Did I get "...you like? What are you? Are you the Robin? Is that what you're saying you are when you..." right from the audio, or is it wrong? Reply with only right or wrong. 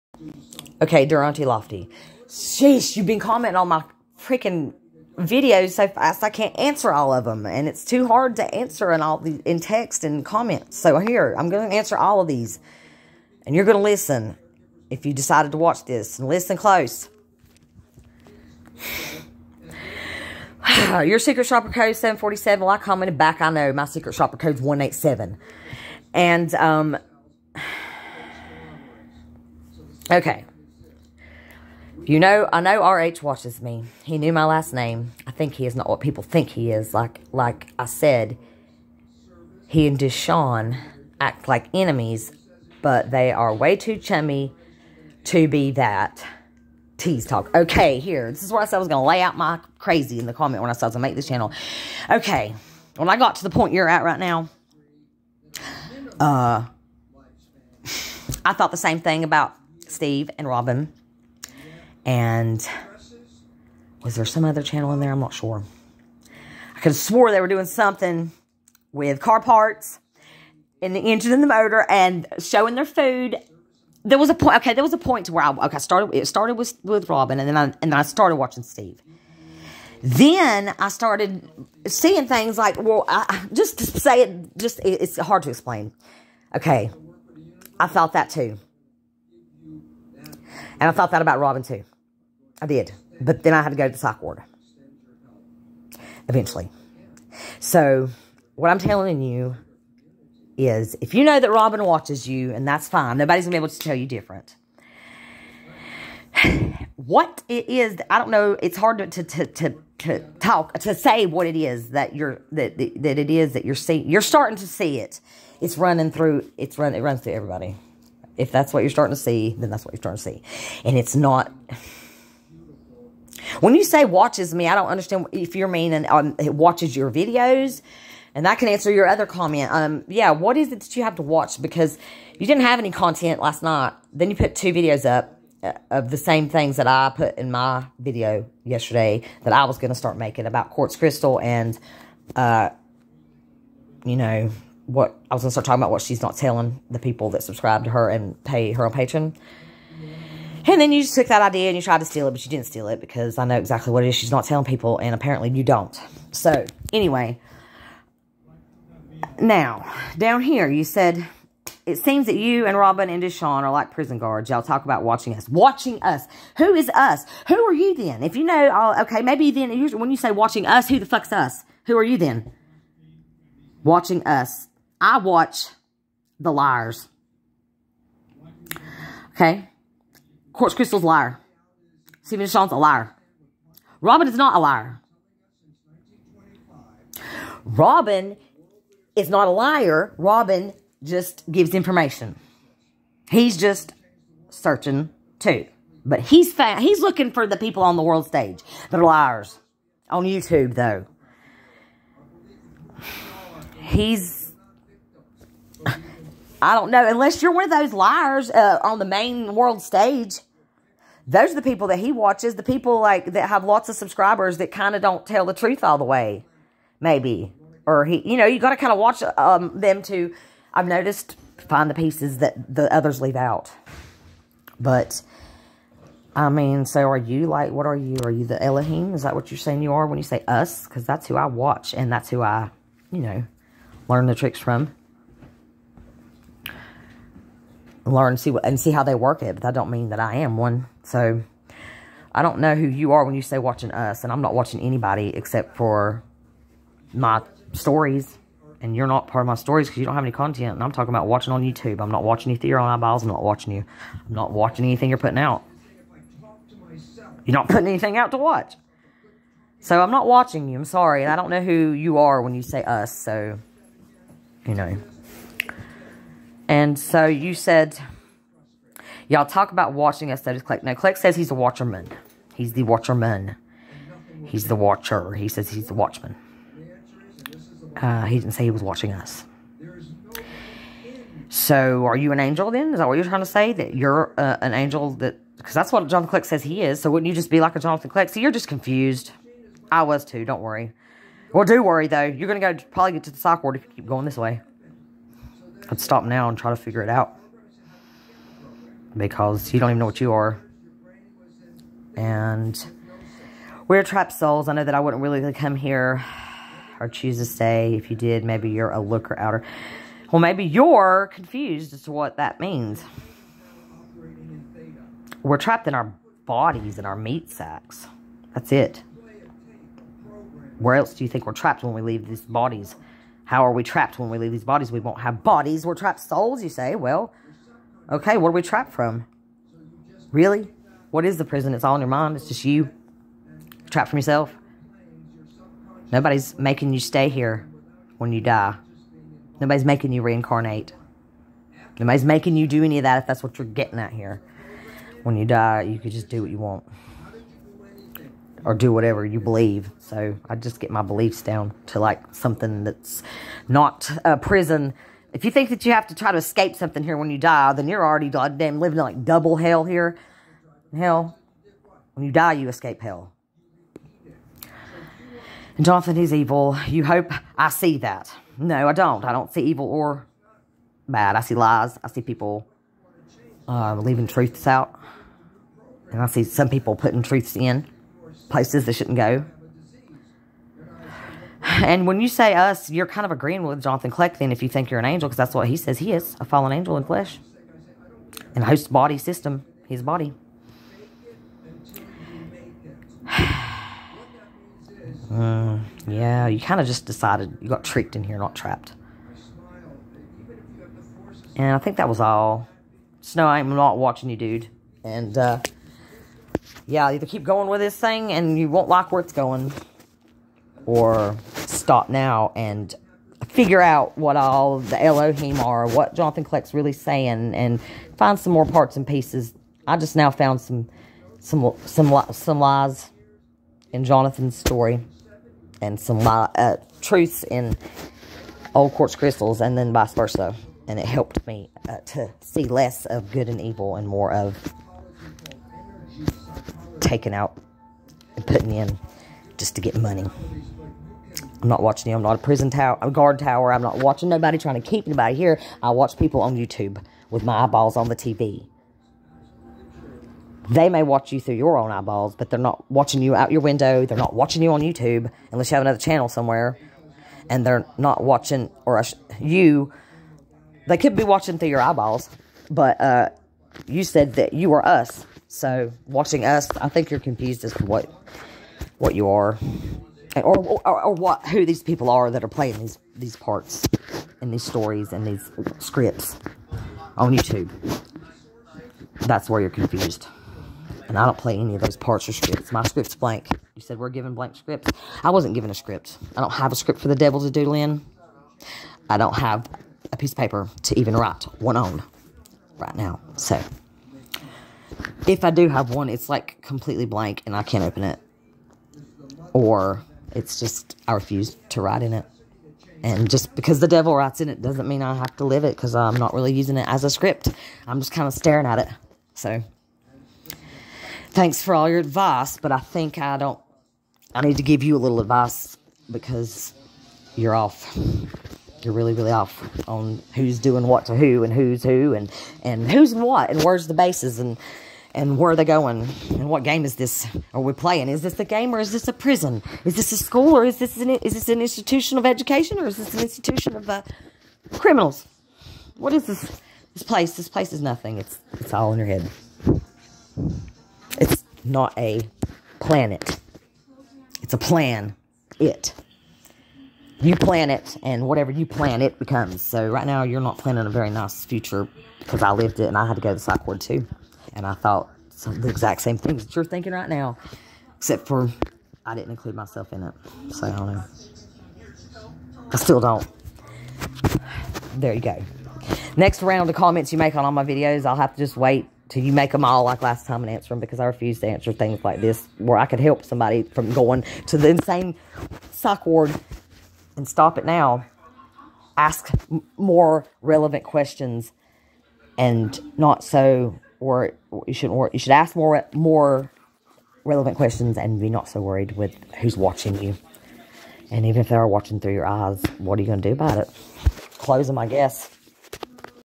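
wrong.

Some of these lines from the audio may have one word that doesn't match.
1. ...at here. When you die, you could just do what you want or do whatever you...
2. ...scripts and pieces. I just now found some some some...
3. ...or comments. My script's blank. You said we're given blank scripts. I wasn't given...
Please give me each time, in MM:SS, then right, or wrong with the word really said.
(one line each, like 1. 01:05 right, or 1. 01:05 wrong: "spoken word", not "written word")
1. 05:43 right
2. 06:58 wrong: "parts", not "scripts"
3. 08:02 wrong: "scripts", not "comments".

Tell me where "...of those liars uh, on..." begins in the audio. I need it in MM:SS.
03:27.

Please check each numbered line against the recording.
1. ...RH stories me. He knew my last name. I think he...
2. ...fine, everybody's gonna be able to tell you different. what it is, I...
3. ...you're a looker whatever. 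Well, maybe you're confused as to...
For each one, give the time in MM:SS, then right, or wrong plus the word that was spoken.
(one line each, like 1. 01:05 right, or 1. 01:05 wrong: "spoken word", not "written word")
1. 00:32 wrong: "watches", not "stories"
2. 01:42 wrong: "nobody", not "everybody"
3. 05:08 wrong: "outer", not "whatever".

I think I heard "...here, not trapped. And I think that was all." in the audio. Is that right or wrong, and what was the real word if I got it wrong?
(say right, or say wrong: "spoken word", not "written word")
right.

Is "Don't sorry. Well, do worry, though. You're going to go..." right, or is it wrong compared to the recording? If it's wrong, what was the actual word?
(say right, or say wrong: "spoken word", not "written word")
wrong: "worry", not "sorry".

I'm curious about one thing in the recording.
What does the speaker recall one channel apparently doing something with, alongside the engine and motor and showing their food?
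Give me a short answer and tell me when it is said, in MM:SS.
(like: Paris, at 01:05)
Car parts, at 01:09.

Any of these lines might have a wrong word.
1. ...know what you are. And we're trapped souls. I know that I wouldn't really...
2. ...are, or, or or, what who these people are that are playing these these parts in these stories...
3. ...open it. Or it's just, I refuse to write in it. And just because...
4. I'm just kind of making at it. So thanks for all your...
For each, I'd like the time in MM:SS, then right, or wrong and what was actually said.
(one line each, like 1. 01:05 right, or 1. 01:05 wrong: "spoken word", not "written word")
1. 04:59 right
2. 07:49 right
3. 08:17 right
4. 08:27 wrong: "staring", not "making".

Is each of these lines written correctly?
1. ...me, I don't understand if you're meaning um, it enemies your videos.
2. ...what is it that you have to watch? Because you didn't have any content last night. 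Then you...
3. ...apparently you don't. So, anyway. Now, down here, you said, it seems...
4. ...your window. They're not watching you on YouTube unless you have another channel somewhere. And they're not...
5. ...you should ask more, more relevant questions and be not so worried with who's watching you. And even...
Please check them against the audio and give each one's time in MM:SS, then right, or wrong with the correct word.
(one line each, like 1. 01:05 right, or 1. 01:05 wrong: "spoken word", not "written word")
1. 02:04 wrong: "watches", not "enemies"
2. 02:10 right
3. 02:35 right
4. 07:33 right
5. 09:45 right.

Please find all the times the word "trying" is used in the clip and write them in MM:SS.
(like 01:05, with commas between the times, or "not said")
04:43, 07:24.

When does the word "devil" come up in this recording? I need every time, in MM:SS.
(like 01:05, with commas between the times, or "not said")
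08:07, 08:23.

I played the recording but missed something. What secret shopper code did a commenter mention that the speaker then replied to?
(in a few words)
747.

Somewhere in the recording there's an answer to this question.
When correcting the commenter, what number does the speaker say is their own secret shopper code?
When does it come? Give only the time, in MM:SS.
00:24.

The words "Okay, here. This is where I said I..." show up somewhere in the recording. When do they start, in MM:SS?
00:47.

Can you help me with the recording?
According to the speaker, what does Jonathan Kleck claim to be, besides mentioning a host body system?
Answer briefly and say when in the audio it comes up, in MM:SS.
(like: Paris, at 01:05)
A fallen angel in flesh, at 06:26.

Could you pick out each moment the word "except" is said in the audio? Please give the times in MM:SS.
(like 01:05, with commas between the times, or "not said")
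04:05, 09:17.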